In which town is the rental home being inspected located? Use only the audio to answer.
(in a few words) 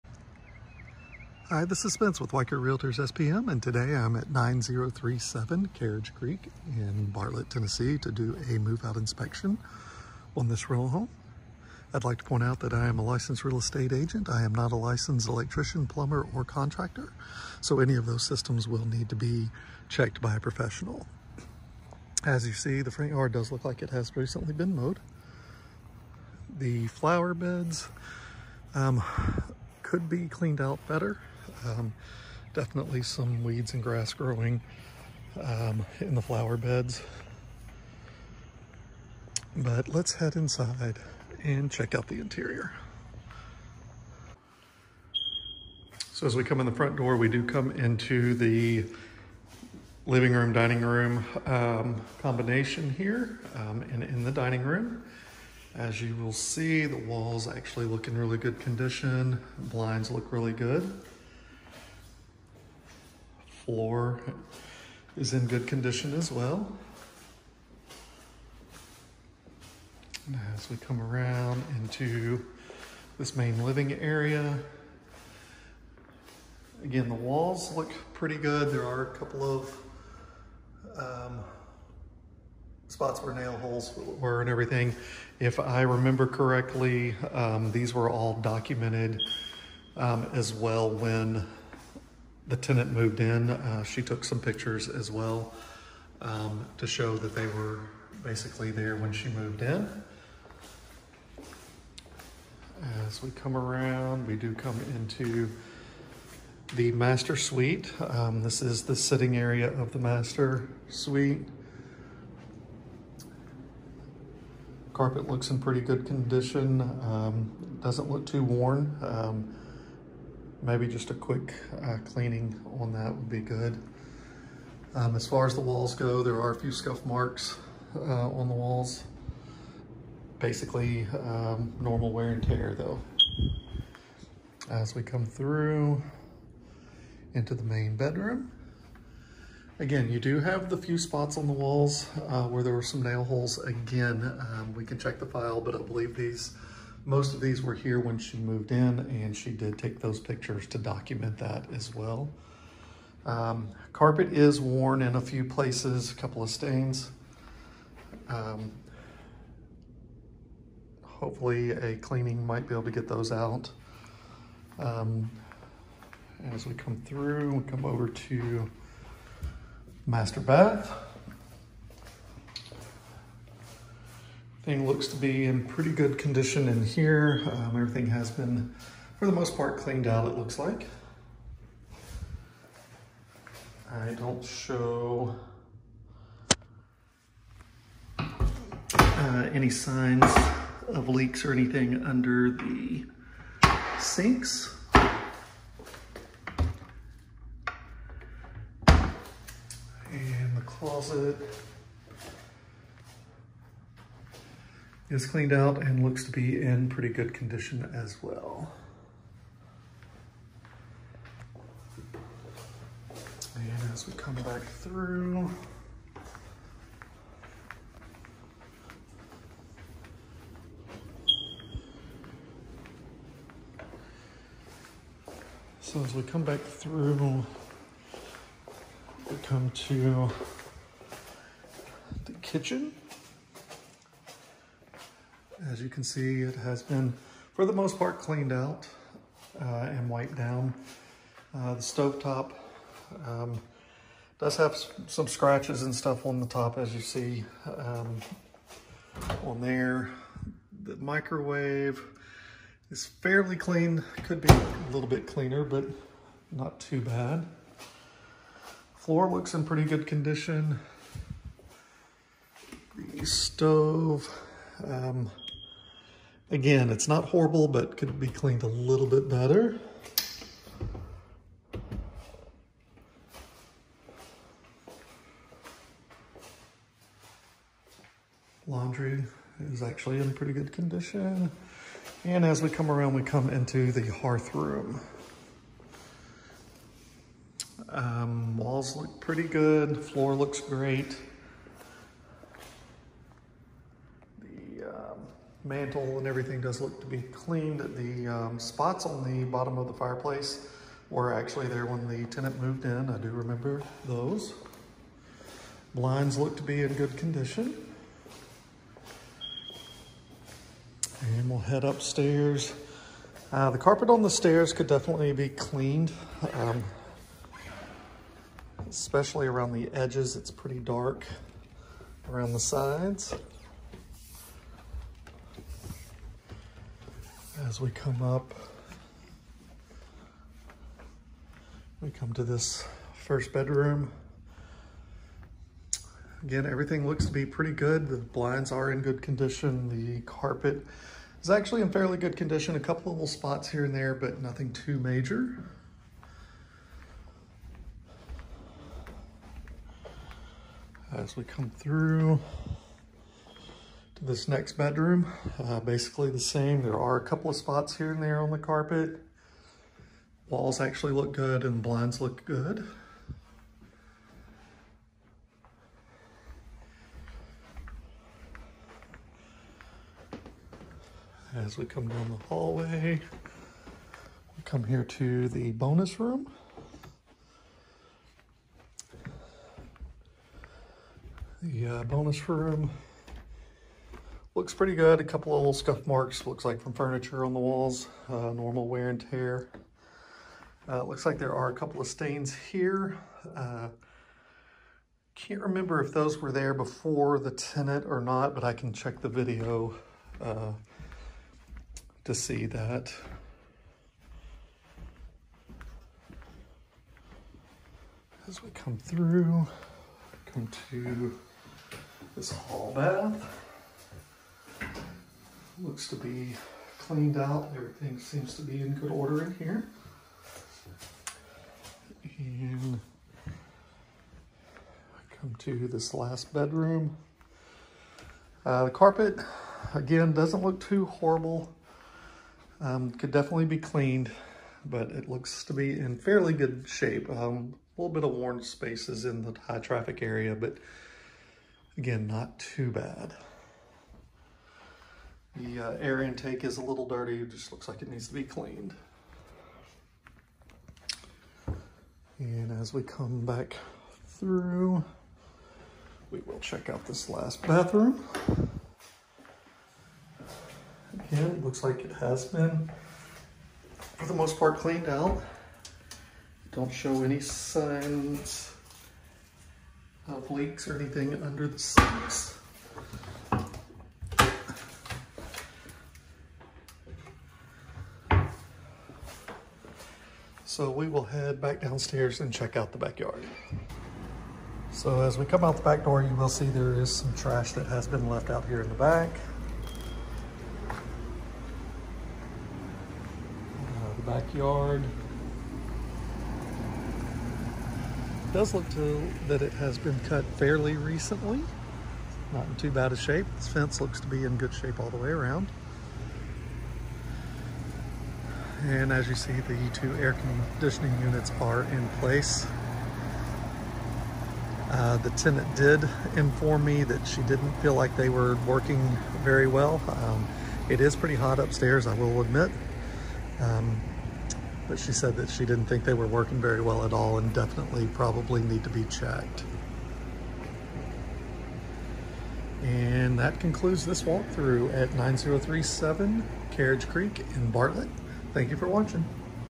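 Bartlett, Tennessee.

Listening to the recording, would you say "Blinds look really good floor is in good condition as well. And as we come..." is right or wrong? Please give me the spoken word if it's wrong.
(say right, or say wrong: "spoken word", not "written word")
right.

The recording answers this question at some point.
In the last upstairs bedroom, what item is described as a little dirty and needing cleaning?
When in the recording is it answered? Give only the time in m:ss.
7:25.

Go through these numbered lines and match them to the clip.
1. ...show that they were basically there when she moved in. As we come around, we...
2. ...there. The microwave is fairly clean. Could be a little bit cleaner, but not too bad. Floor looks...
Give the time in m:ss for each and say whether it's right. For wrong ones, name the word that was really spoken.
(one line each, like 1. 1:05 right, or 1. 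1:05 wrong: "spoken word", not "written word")
1. 1:36 right
2. 4:09 right.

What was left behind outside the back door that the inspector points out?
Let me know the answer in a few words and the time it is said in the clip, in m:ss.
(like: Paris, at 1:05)
Trash, at 8:07.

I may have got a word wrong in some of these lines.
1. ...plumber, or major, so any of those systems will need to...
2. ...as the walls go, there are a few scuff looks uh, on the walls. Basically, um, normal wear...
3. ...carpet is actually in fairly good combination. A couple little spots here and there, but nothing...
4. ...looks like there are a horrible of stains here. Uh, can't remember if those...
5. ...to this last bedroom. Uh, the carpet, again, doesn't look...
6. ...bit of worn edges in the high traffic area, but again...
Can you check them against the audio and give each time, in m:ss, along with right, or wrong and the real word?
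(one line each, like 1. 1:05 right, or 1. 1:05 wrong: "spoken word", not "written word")
1. 0:15 wrong: "contractor", not "major"
2. 2:05 wrong: "marks", not "looks"
3. 5:40 wrong: "condition", not "combination"
4. 6:31 wrong: "couple", not "horrible"
5. 7:05 right
6. 7:18 wrong: "spaces", not "edges".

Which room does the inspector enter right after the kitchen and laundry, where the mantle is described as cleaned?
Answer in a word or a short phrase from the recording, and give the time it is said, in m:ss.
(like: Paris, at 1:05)
Hearth room, at 4:44.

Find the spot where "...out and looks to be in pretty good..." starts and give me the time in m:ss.
3:25.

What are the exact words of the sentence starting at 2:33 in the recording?
Um, carpet is worn in a few places, a couple of stains.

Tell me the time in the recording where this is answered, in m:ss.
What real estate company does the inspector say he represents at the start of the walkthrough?
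0:02.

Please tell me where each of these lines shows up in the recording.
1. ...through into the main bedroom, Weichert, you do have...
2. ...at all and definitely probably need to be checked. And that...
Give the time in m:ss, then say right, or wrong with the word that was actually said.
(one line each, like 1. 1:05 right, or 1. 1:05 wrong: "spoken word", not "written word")
1. 2:15 wrong: "Again", not "Weichert"
2. 8:47 right.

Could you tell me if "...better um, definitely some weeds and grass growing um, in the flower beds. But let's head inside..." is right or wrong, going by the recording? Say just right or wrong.
right.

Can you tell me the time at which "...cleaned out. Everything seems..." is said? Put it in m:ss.
6:56.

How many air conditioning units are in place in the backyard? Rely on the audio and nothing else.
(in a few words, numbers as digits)
2.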